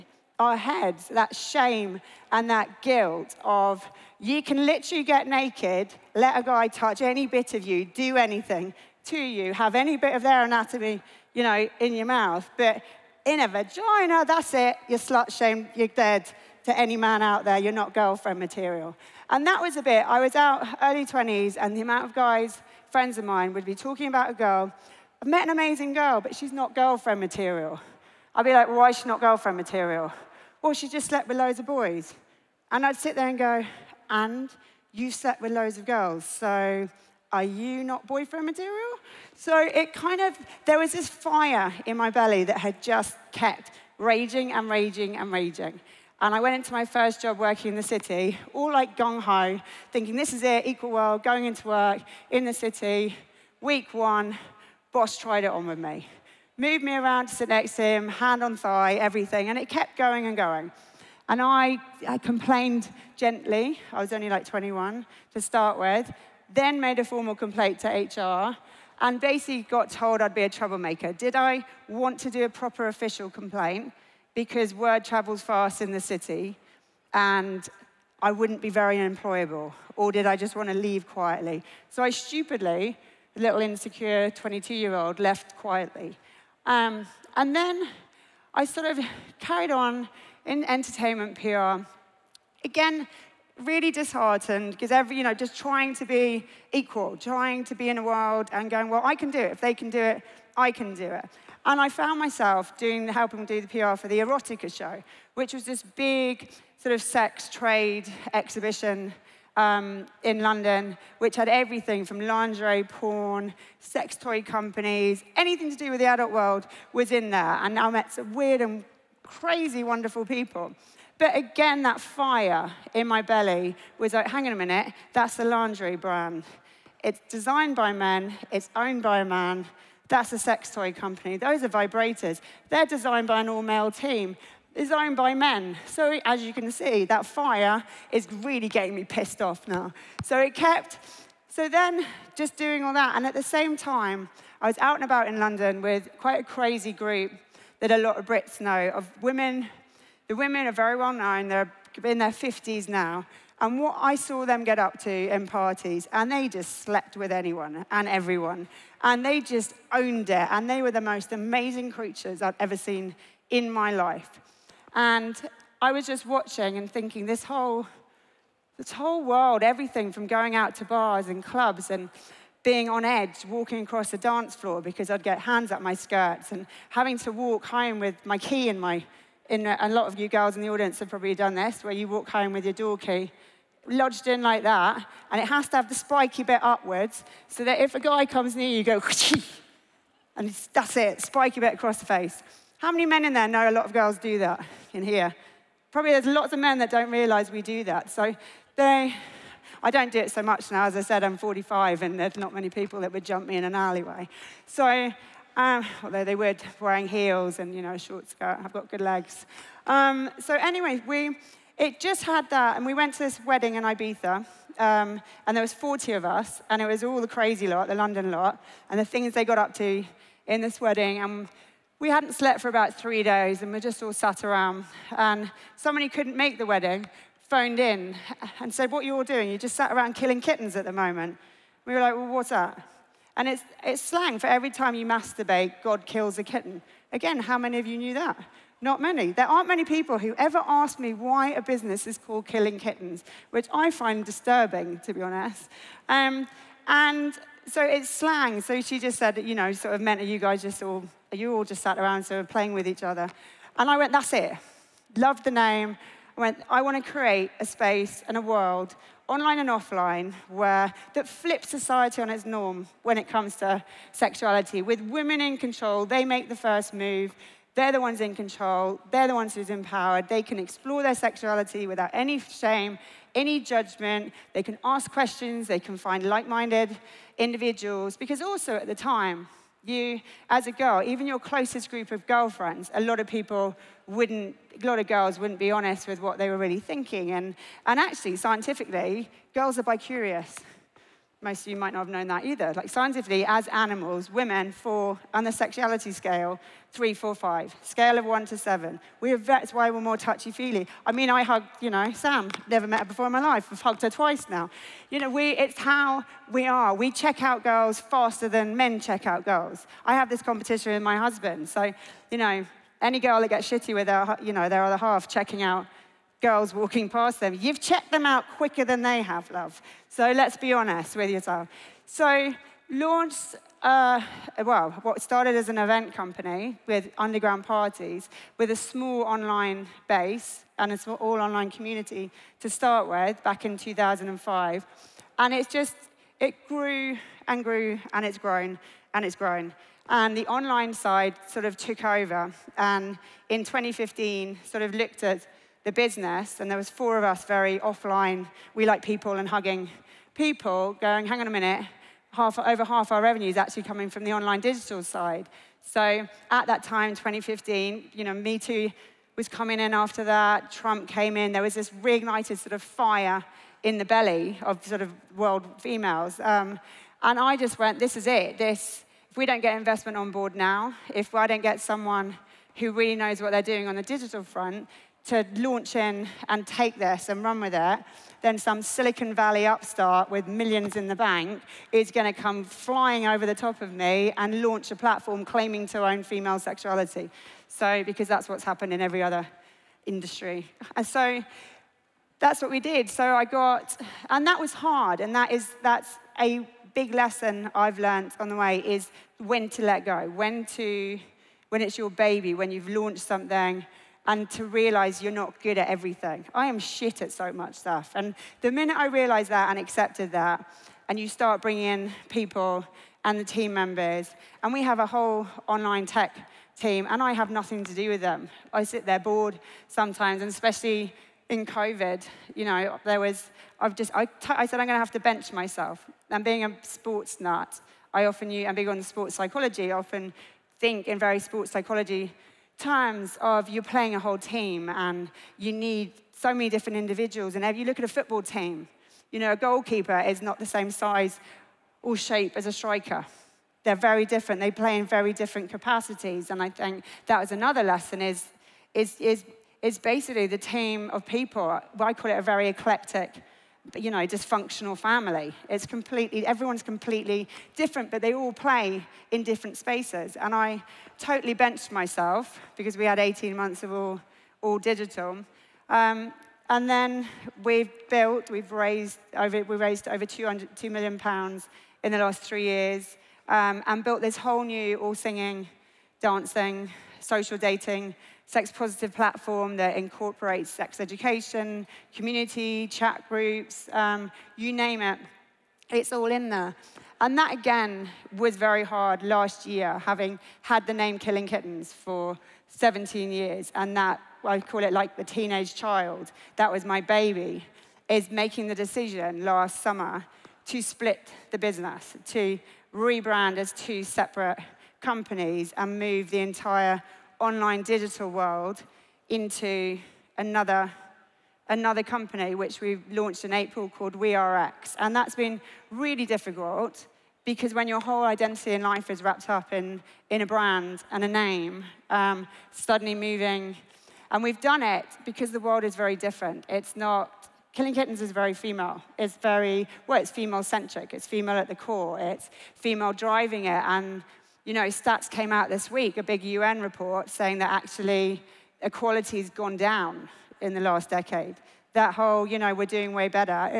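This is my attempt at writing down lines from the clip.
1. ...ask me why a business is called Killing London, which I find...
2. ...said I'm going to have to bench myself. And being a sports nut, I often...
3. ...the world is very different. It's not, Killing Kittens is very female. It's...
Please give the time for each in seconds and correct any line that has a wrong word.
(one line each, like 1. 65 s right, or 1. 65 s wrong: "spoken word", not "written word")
1. 240 s wrong: "Kittens", not "London"
2. 424 s right
3. 525 s right.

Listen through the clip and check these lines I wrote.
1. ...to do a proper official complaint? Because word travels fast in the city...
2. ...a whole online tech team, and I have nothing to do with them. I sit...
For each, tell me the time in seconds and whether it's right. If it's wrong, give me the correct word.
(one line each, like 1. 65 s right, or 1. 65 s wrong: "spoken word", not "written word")
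1. 72 s right
2. 414 s right.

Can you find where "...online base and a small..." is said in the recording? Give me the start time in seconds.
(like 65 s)
329 s.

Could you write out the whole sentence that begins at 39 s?
So it kind of, there was this fire in my belly that had just kept raging and raging and raging.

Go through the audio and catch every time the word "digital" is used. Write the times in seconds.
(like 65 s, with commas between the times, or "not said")
354 s, 374 s, 464 s, 507 s.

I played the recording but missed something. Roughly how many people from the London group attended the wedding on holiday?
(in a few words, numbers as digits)
40.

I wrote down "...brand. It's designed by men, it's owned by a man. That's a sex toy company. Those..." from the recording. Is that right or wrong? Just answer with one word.
right.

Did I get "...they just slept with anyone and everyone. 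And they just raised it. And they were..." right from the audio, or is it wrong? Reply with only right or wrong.
wrong.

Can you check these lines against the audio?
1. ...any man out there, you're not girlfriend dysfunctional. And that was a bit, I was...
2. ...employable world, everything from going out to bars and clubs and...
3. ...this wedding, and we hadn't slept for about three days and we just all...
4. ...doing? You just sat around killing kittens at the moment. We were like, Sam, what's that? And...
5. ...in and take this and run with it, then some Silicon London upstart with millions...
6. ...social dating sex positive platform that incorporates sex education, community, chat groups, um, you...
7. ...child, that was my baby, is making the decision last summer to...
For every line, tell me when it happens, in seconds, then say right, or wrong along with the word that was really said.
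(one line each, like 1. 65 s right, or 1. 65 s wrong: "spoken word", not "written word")
1. 16 s wrong: "material", not "dysfunctional"
2. 168 s wrong: "whole", not "employable"
3. 220 s right
4. 229 s wrong: "Well", not "Sam"
5. 375 s wrong: "Valley", not "London"
6. 477 s right
7. 495 s right.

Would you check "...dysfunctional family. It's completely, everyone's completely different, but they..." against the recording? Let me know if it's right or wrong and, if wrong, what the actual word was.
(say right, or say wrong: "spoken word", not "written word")
right.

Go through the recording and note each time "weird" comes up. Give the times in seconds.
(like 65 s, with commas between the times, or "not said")
118 s.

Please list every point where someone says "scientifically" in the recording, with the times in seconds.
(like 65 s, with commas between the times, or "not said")
288 s, 292 s.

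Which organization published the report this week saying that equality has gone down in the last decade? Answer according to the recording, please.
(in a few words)
UN.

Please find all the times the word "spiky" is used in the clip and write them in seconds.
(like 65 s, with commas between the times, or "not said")
185 s, 191 s.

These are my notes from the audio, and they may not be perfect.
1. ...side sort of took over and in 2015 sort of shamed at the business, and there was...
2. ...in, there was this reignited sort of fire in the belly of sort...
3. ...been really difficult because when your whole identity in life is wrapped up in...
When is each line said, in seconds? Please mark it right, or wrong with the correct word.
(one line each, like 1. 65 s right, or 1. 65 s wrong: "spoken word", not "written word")
1. 340 s wrong: "looked", not "shamed"
2. 361 s right
3. 515 s right.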